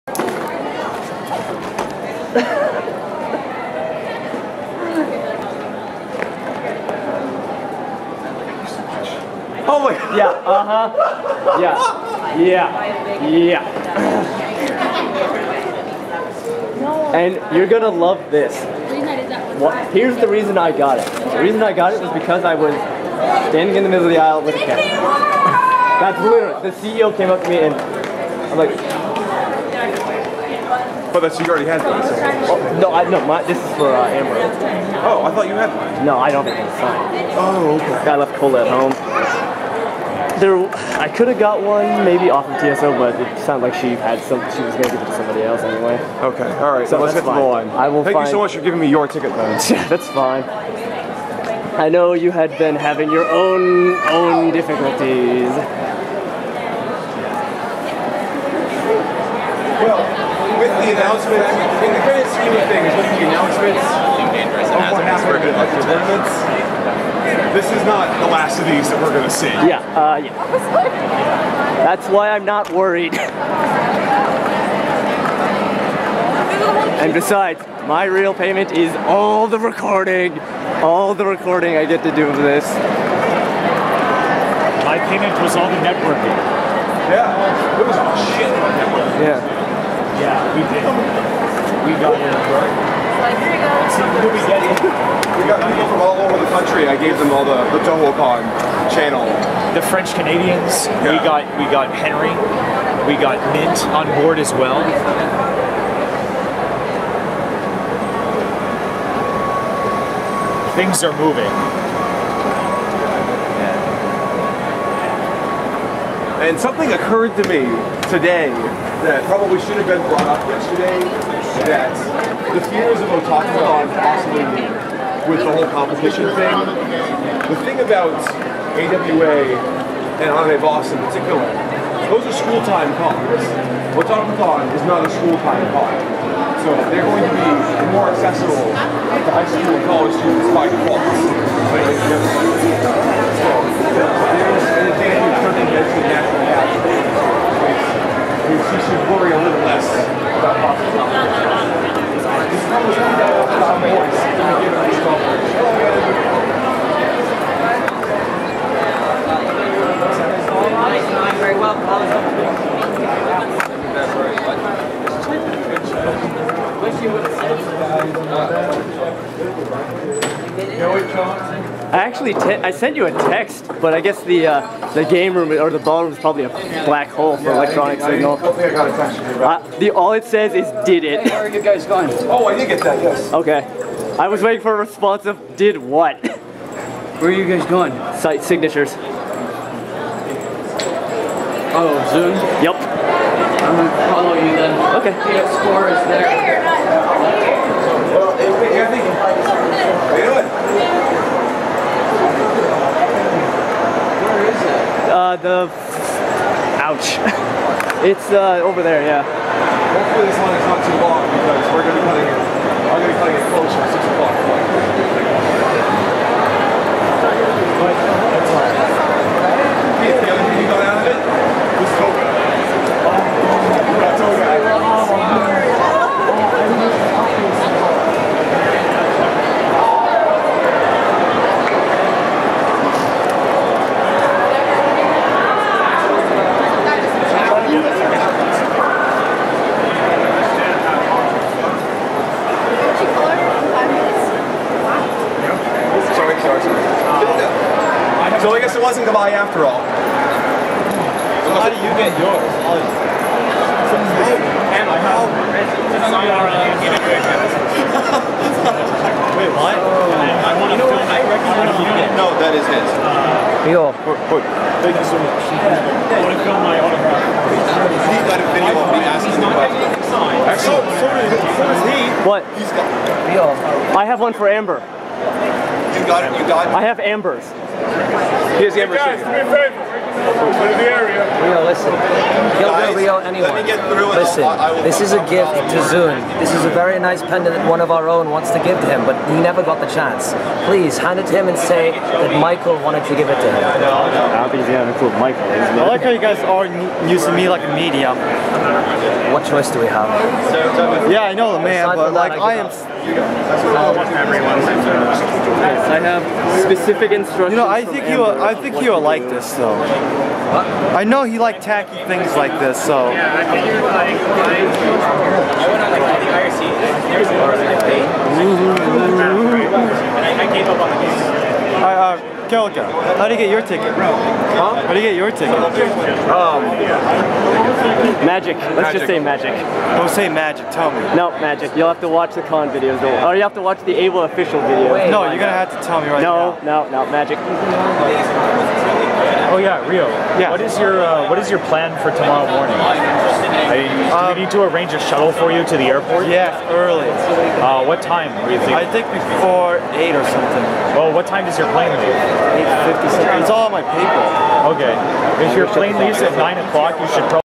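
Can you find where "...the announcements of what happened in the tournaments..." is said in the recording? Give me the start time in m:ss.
1:03.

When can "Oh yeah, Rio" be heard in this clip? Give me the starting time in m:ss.
5:39.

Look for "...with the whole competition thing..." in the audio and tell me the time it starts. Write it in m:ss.
2:05.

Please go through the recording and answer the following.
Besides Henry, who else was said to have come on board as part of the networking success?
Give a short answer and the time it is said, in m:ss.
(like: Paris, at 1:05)
Mint, at 1:43.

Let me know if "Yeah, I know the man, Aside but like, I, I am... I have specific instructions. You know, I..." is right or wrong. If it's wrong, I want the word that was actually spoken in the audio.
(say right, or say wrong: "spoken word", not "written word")
right.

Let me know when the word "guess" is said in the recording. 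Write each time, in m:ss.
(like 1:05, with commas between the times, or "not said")
2:54, 4:08.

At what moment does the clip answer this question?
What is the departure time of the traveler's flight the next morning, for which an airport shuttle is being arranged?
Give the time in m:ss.
5:52.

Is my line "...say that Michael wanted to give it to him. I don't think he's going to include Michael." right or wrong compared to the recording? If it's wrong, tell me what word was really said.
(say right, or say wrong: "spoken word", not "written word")
right.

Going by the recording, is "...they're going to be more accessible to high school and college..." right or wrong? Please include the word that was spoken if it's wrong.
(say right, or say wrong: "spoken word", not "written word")
right.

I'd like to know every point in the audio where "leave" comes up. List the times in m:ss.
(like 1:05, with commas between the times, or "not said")
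5:51, 5:55.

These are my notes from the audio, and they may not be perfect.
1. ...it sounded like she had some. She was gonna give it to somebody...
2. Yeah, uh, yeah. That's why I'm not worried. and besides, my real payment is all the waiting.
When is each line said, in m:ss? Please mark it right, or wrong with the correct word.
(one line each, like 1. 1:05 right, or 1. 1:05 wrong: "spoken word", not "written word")
1. 0:43 right
2. 1:09 wrong: "recording", not "waiting".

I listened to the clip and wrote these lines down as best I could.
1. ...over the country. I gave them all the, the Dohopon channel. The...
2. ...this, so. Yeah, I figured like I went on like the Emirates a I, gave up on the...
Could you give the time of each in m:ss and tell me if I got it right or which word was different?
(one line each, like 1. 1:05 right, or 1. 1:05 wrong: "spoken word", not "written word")
1. 1:36 right
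2. 5:12 wrong: "IRC", not "Emirates".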